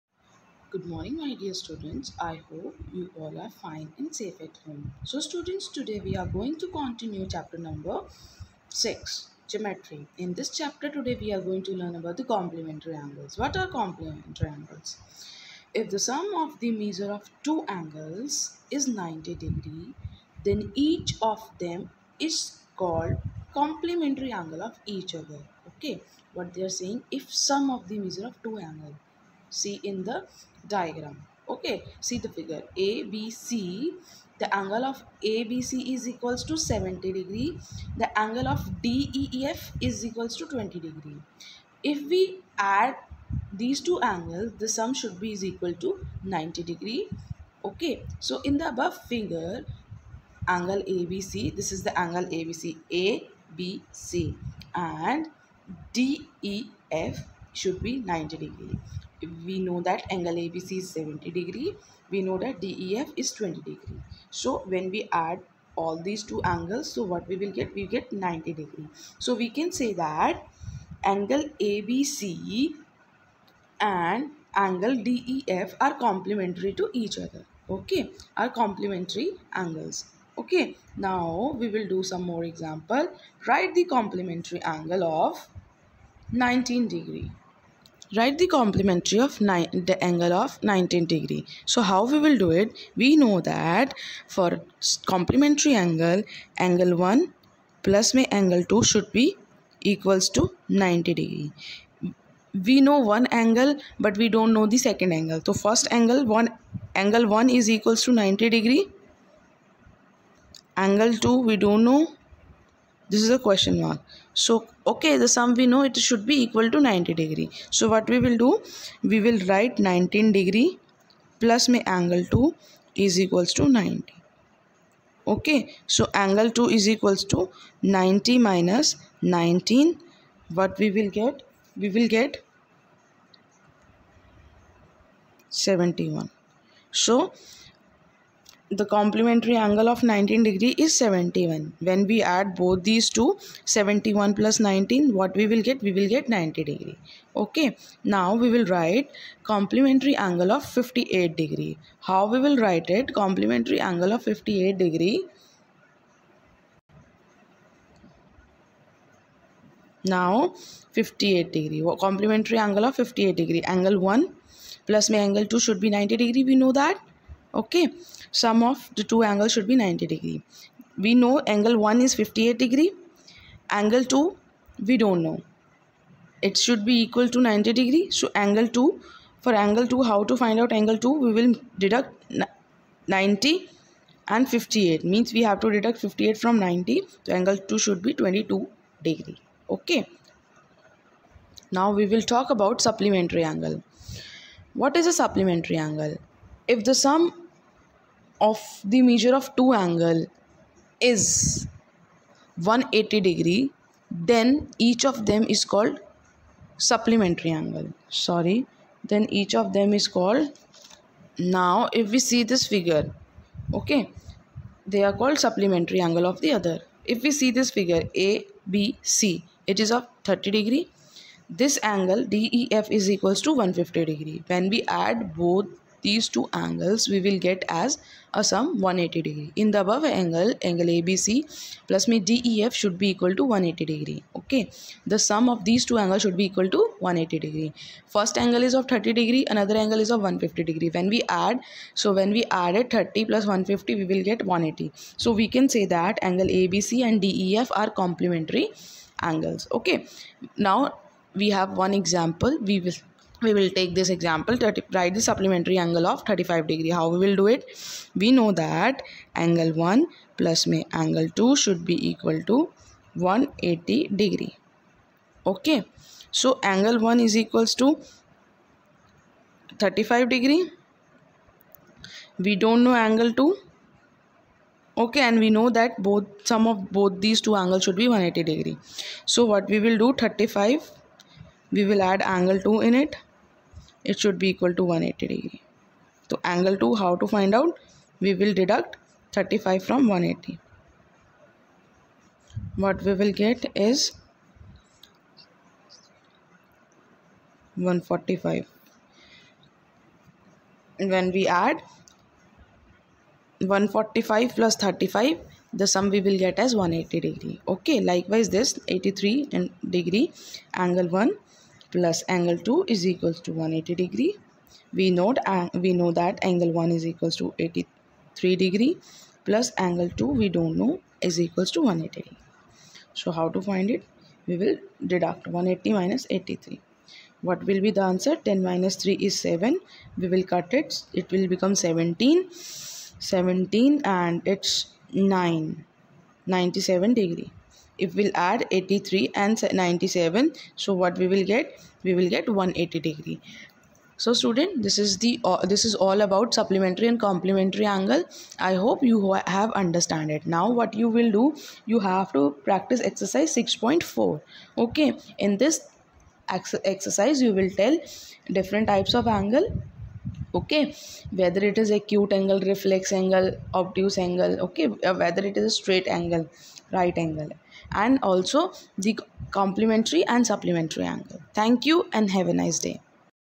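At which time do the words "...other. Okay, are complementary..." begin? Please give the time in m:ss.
1:17.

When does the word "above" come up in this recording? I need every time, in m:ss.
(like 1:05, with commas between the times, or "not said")
0:48, 3:49.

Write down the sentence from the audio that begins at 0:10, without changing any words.
In this chapter today we are going to learn about the complementary angles.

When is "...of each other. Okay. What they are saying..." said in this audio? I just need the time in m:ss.
0:24.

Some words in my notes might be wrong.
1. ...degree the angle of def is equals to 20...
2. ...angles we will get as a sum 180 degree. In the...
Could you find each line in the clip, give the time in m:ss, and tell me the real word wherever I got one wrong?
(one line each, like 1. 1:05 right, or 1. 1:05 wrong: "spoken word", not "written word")
1. 0:37 right
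2. 3:46 right.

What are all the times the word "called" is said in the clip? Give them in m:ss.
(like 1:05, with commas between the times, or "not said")
0:22, 3:25, 3:30, 3:35.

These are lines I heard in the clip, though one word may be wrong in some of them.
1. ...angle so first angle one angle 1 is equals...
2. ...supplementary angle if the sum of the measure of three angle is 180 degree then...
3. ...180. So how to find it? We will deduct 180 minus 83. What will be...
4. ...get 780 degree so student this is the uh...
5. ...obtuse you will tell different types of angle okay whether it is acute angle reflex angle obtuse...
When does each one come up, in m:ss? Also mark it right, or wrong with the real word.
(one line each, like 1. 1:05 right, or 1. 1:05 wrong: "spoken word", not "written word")
1. 1:45 right
2. 3:15 wrong: "two", not "three"
3. 5:21 right
4. 5:42 wrong: "180", not "780"
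5. 5:56 wrong: "exercise", not "obtuse".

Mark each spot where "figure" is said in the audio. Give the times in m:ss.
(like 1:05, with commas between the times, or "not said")
0:32, 0:49, 3:32, 3:37.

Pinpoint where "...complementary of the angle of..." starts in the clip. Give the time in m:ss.
1:28.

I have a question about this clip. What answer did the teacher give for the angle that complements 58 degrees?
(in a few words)
22 degrees.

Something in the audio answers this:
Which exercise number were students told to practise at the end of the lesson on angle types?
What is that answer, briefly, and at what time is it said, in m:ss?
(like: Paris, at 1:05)
6.4, at 5:53.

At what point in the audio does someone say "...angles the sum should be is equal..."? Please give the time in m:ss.
0:44.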